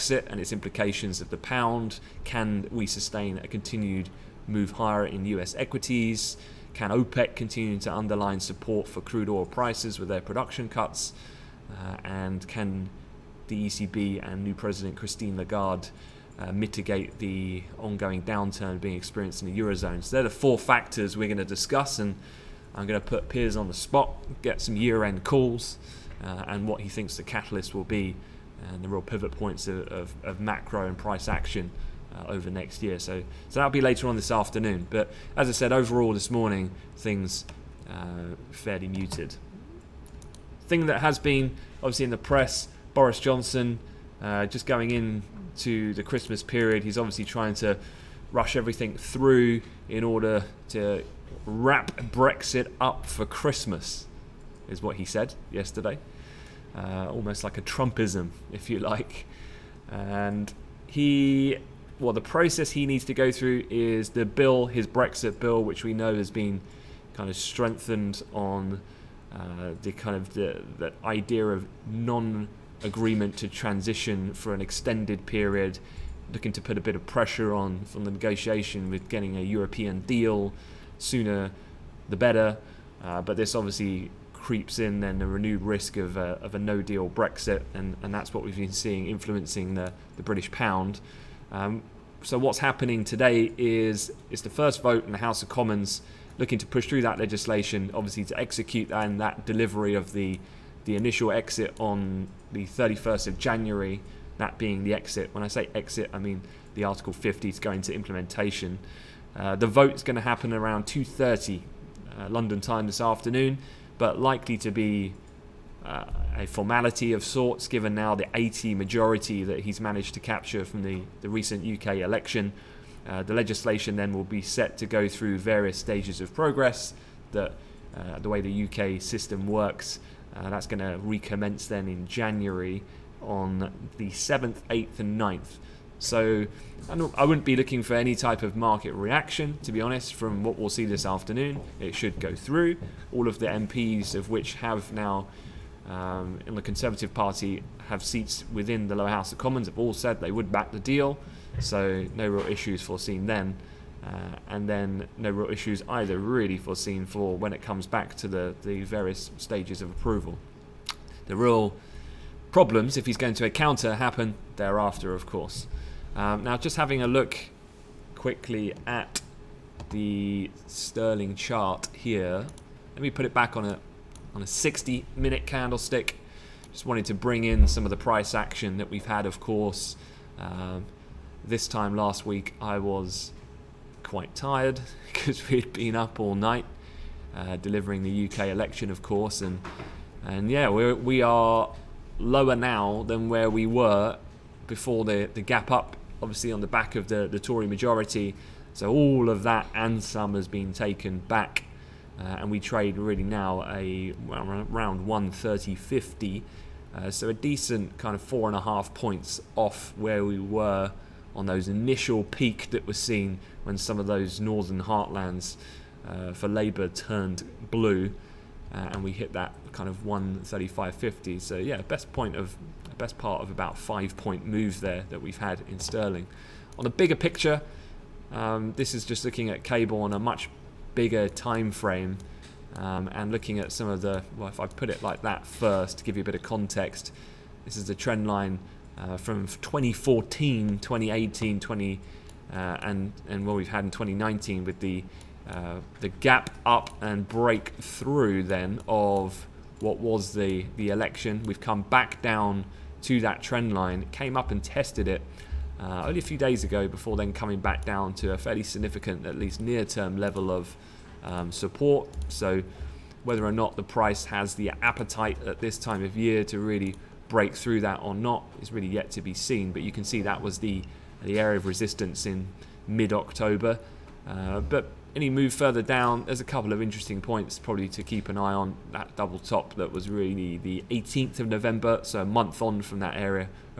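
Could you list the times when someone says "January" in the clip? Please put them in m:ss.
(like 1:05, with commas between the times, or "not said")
1:43, 2:12.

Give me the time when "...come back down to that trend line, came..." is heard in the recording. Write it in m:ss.
4:11.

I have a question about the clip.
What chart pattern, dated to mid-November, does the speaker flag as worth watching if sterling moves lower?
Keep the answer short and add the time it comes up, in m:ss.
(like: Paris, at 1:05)
Double top, at 4:39.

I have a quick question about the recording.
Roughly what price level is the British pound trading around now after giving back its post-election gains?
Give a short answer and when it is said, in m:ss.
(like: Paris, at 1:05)
130.50, at 3:25.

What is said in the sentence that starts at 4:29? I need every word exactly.
But you can see that was the, the area of resistance in mid-October.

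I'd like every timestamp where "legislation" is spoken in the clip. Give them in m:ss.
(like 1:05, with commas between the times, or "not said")
1:37, 2:03.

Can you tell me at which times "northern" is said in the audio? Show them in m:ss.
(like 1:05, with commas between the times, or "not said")
3:34.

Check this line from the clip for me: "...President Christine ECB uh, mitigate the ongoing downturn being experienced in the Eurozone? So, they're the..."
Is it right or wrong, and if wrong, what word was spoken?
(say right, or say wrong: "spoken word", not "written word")
wrong: "Lagarde", not "ECB".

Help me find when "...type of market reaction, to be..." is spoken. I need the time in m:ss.
2:18.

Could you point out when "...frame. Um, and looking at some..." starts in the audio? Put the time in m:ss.
3:51.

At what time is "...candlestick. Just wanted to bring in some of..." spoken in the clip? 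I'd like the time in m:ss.
2:55.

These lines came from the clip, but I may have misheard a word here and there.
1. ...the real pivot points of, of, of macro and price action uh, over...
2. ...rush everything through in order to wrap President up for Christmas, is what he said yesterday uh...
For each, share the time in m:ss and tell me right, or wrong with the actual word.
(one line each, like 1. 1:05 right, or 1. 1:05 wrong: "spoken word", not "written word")
1. 0:28 right
2. 0:48 wrong: "Brexit", not "President".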